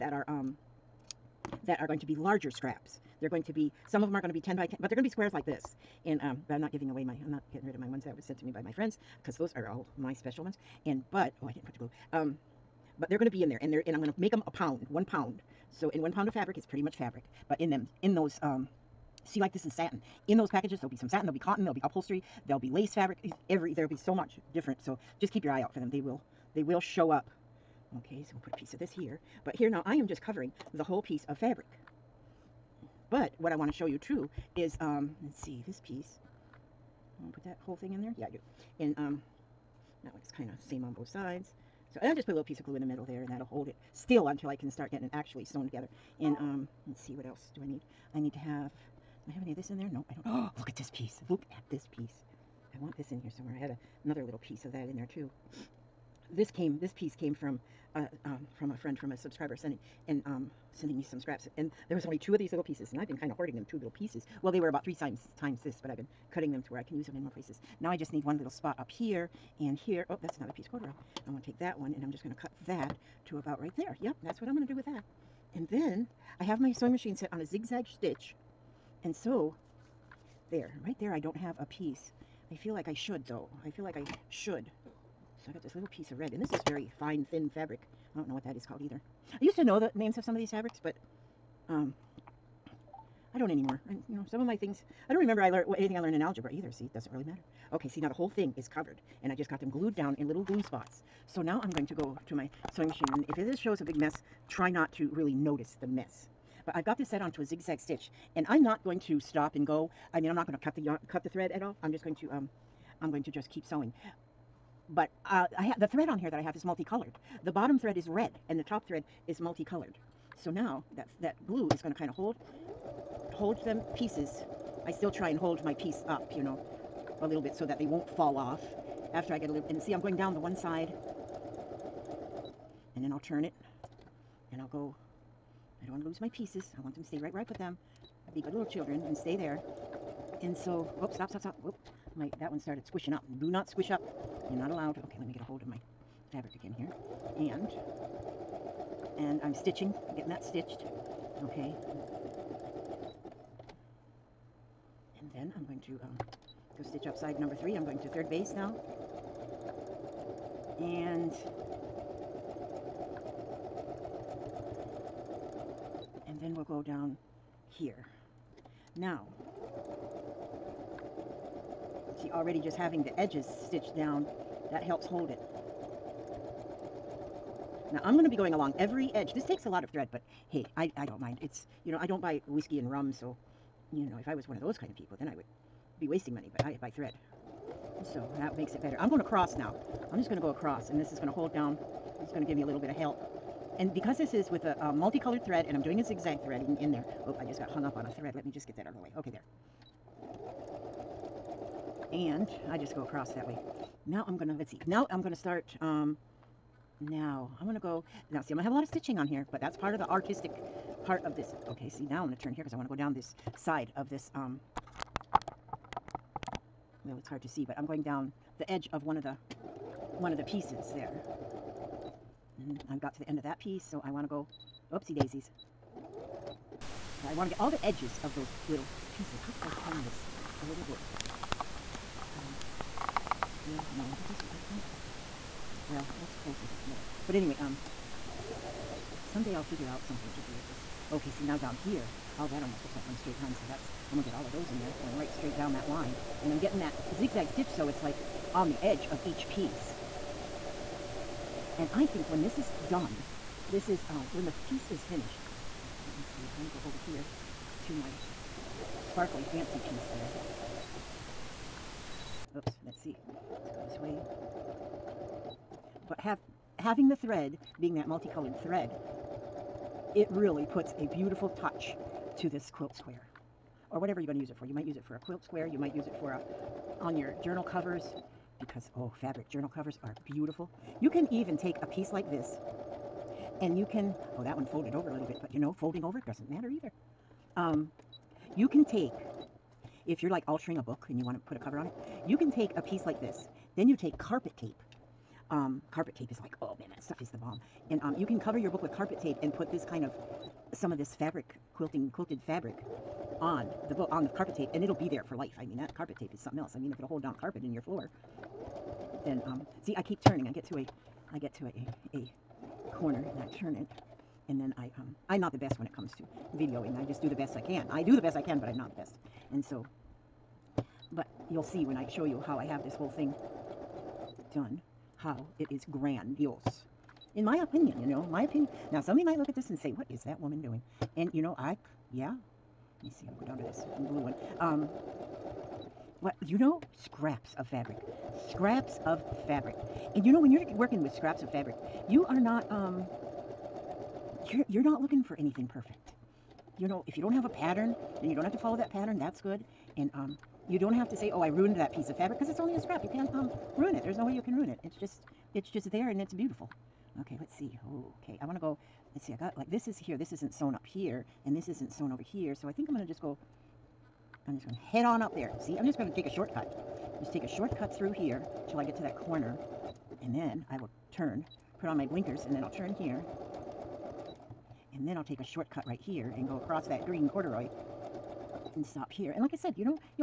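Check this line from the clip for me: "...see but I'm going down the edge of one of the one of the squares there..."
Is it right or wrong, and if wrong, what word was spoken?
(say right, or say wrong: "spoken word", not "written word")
wrong: "pieces", not "squares".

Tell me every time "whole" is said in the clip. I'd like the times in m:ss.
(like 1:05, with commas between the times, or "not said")
0:30, 0:37, 1:38, 5:22.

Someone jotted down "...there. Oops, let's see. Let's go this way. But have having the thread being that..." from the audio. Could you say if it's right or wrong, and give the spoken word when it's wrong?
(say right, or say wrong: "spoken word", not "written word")
right.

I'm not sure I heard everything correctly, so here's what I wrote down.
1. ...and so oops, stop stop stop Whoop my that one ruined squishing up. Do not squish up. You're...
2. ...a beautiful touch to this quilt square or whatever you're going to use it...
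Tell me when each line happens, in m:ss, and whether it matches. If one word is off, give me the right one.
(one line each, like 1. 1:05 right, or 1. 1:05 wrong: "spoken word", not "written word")
1. 2:20 wrong: "started", not "ruined"
2. 4:30 right.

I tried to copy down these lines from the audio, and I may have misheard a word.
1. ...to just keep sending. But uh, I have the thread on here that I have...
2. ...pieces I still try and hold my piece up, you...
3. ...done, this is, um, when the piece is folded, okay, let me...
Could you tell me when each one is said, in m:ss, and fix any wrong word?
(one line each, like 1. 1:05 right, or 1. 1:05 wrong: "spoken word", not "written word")
1. 1:53 wrong: "sewing", not "sending"
2. 2:03 right
3. 4:12 wrong: "finished", not "folded".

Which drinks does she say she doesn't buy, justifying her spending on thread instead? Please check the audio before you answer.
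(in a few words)
whiskey and rum.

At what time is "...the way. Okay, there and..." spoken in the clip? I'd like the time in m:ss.
3:18.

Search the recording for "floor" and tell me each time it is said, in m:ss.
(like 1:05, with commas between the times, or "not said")
5:07.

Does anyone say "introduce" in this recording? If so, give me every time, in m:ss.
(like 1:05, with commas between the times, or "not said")
not said.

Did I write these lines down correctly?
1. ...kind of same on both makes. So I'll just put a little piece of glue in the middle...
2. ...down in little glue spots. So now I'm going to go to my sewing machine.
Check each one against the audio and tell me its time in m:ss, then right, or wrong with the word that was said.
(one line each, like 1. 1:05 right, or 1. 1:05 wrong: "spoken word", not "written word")
1. 0:40 wrong: "sides", not "makes"
2. 1:39 right.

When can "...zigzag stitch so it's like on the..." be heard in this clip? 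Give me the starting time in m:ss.
4:07.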